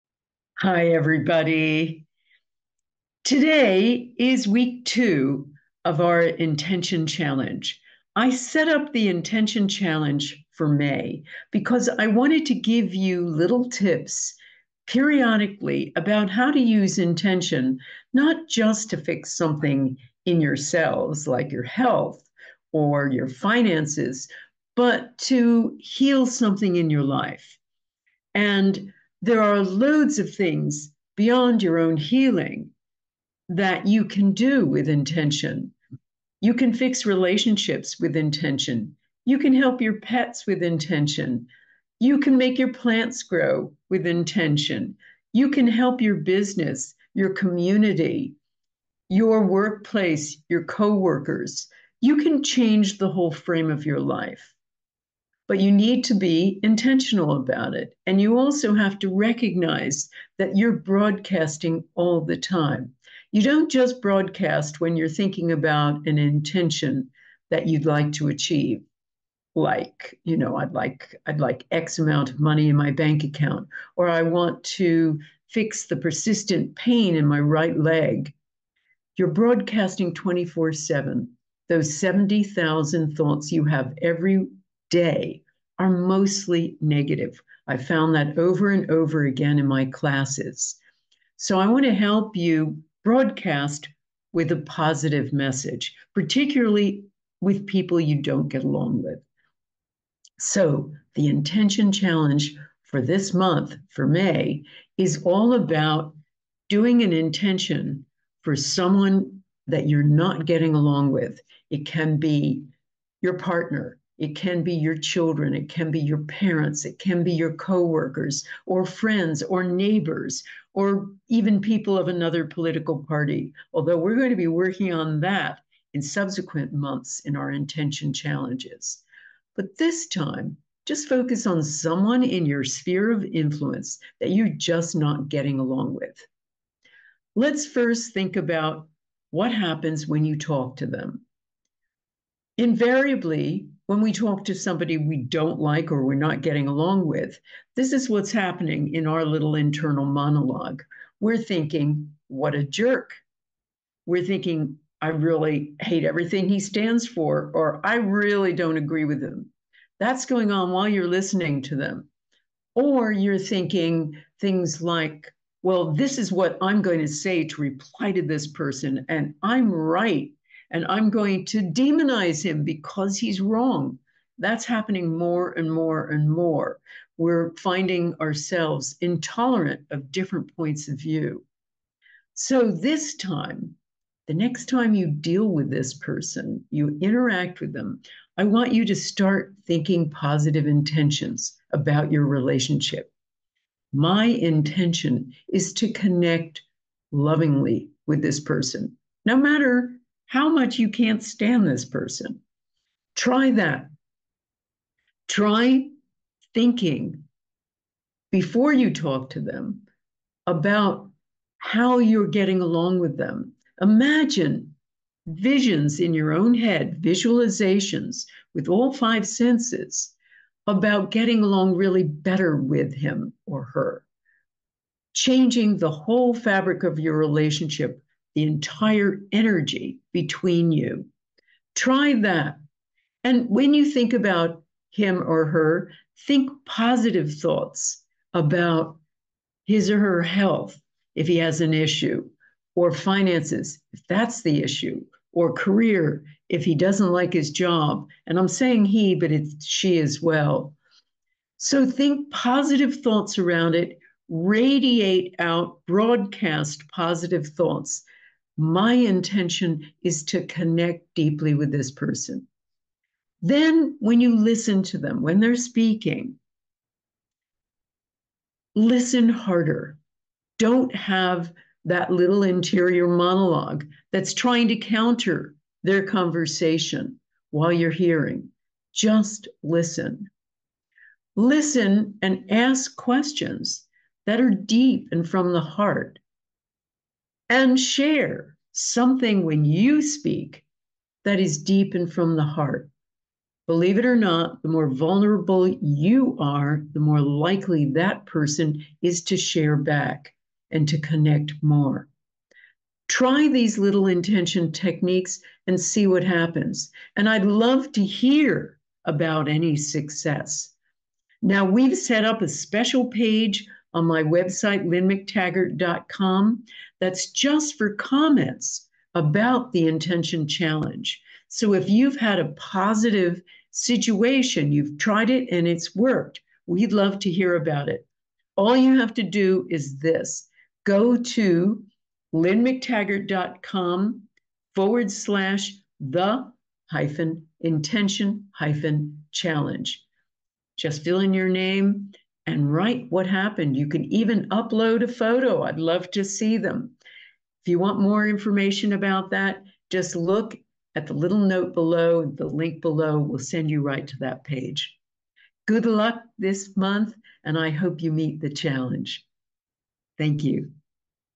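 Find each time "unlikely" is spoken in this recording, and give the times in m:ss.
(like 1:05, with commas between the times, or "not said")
not said.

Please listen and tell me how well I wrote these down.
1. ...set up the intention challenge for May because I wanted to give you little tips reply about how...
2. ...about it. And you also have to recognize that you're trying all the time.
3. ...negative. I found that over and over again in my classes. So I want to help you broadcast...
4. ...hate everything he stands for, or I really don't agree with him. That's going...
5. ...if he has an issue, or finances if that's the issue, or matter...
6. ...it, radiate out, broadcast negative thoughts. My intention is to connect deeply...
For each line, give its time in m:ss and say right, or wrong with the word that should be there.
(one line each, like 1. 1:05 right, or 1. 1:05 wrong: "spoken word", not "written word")
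1. 0:08 wrong: "periodically", not "reply"
2. 0:57 wrong: "broadcasting", not "trying"
3. 1:26 right
4. 2:35 right
5. 4:01 wrong: "career", not "matter"
6. 4:13 wrong: "positive", not "negative".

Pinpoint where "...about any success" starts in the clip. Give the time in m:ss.
5:09.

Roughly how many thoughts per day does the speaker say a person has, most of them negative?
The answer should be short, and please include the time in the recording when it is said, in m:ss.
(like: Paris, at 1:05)
70,000, at 1:21.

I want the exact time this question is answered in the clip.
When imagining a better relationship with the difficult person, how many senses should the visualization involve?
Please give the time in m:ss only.
3:38.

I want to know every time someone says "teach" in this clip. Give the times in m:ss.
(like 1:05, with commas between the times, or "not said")
not said.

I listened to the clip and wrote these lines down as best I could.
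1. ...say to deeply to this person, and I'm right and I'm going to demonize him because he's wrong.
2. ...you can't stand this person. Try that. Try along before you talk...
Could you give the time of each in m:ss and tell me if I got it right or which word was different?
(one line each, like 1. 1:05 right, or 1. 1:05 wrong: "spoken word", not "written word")
1. 2:47 wrong: "reply", not "deeply"
2. 3:20 wrong: "thinking", not "along".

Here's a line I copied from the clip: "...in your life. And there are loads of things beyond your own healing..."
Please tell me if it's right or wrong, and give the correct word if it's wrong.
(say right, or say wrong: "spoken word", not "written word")
right.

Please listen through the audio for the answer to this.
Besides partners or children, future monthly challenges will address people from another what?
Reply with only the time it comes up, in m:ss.
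2:02.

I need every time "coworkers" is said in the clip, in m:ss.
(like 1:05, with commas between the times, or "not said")
0:50, 1:57.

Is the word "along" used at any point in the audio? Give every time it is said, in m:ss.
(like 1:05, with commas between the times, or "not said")
1:38, 1:50, 2:15, 2:26, 3:32, 3:41.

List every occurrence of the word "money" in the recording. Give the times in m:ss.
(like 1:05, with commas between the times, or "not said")
1:12.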